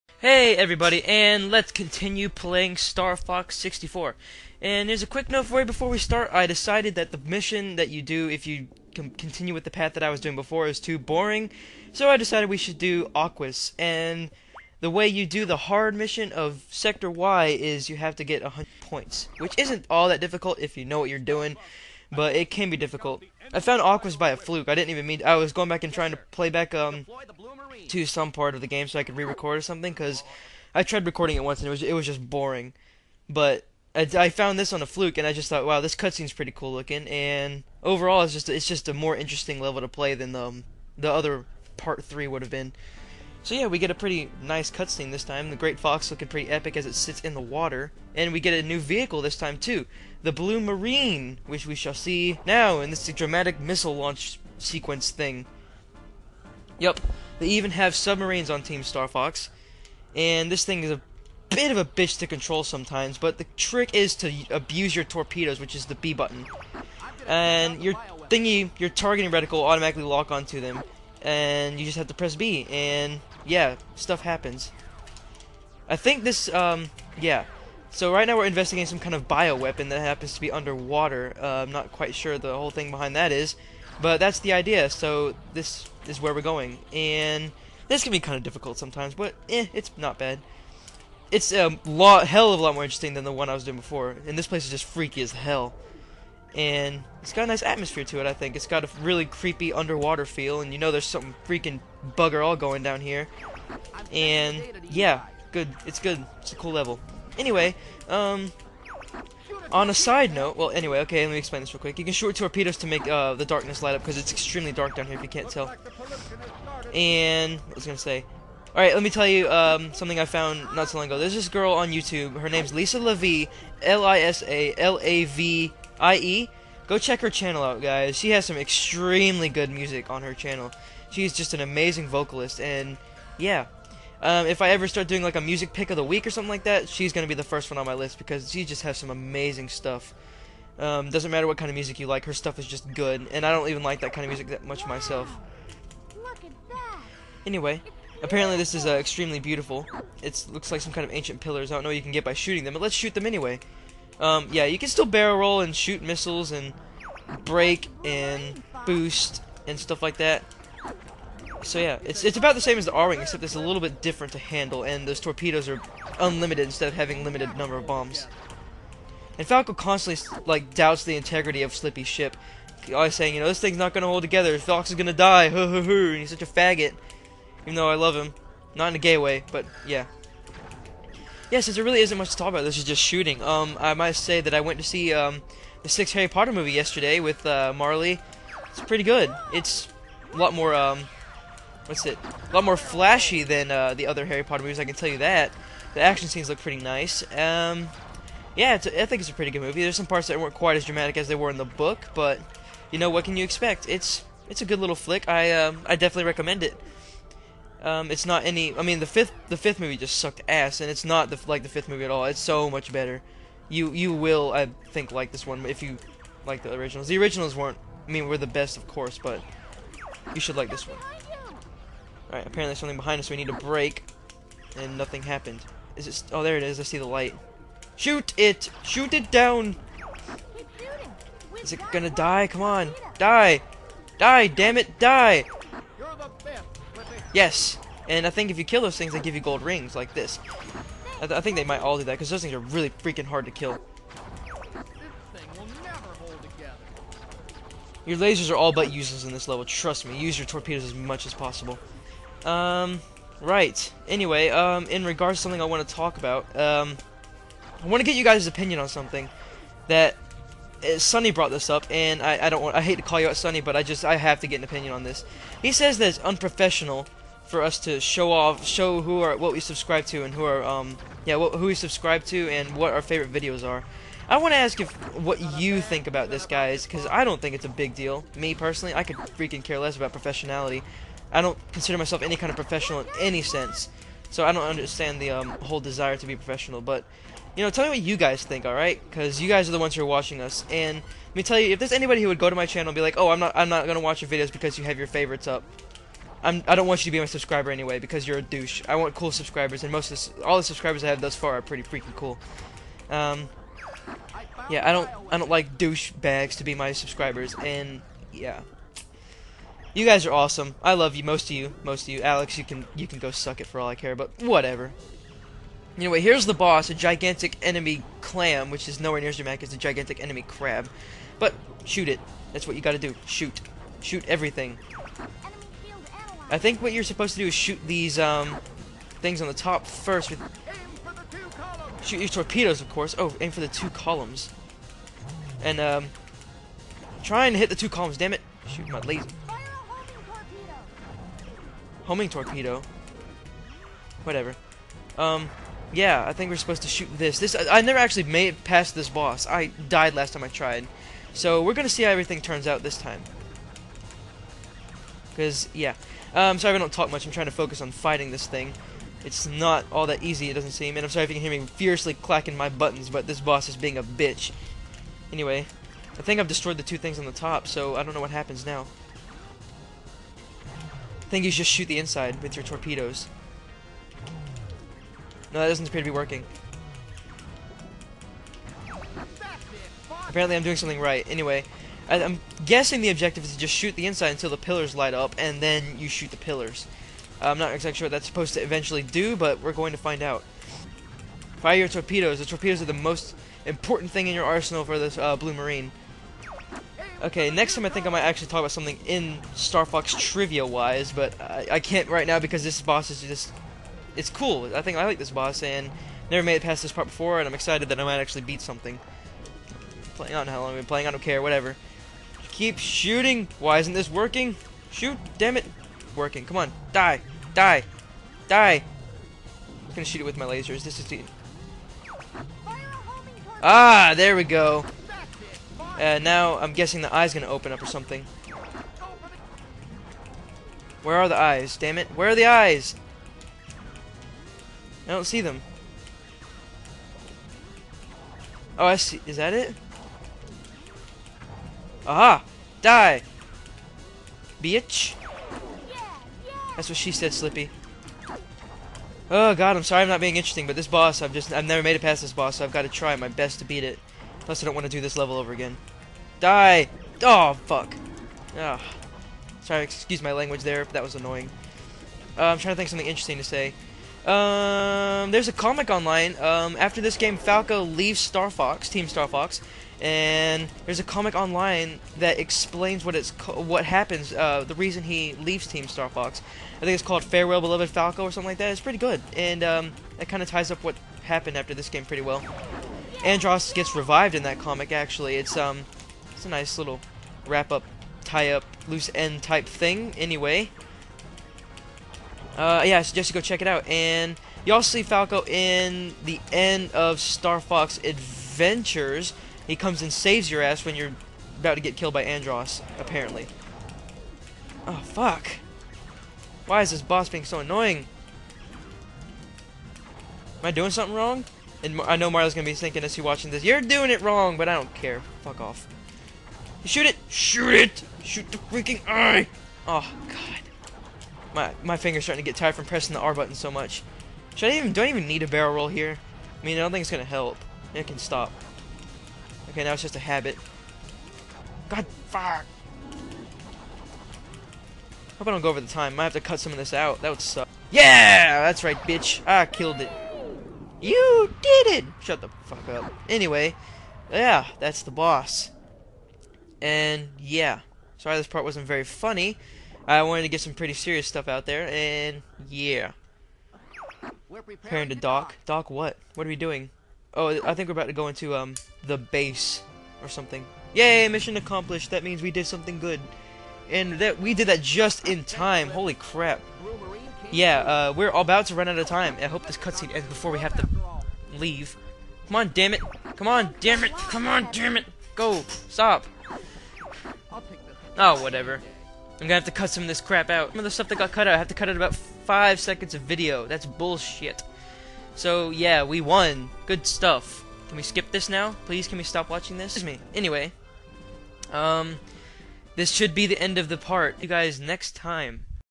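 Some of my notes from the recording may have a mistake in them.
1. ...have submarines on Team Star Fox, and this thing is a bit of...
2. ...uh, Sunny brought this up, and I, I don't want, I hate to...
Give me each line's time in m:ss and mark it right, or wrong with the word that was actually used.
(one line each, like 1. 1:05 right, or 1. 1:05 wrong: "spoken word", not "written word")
1. 0:57 right
2. 4:20 right.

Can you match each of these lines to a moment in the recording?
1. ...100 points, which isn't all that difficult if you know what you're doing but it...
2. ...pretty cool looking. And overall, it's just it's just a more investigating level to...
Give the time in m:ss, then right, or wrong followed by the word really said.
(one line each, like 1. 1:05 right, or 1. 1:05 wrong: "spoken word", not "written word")
1. 0:18 right
2. 0:36 wrong: "interesting", not "investigating".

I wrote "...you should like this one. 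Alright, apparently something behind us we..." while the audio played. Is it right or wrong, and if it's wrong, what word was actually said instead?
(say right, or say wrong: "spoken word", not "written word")
right.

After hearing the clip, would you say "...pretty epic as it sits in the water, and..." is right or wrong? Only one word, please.
right.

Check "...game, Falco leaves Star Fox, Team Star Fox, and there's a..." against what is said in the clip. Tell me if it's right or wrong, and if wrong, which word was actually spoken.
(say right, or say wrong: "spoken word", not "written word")
right.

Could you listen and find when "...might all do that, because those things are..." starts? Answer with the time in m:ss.
4:01.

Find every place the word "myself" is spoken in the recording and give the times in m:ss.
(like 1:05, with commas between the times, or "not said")
2:24, 4:41.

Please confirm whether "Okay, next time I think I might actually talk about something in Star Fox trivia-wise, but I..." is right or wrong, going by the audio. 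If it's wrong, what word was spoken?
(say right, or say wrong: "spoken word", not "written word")
right.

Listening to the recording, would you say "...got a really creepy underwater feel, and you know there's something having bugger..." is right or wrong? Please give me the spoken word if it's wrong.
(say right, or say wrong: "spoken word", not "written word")
wrong: "freaking", not "having".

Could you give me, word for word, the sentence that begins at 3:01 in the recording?
Yeah, since there really isn't much to talk about, this is just shooting.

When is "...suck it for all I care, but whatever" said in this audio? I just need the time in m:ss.
5:13.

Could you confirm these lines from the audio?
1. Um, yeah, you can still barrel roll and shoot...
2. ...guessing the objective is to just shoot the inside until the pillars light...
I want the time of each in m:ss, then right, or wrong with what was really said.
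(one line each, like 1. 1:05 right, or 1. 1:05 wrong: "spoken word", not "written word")
1. 2:34 right
2. 6:22 right.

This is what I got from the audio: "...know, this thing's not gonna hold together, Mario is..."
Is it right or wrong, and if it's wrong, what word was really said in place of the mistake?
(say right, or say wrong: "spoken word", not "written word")
wrong: "Fox", not "Mario".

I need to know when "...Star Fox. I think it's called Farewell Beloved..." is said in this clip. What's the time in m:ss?
7:55.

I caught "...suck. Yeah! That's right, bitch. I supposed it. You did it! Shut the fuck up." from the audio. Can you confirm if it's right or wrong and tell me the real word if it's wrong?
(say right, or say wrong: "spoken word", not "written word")
wrong: "killed", not "supposed".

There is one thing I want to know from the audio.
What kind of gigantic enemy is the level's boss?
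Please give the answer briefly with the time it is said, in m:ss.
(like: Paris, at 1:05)
Clam, at 5:18.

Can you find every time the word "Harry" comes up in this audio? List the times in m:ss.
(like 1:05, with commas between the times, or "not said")
3:06, 3:14.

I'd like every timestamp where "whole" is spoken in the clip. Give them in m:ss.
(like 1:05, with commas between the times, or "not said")
1:22, 4:45.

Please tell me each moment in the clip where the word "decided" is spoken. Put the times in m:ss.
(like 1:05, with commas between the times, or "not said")
0:06, 0:12.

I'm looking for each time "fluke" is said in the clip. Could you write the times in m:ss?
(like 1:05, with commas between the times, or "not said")
0:24, 0:34.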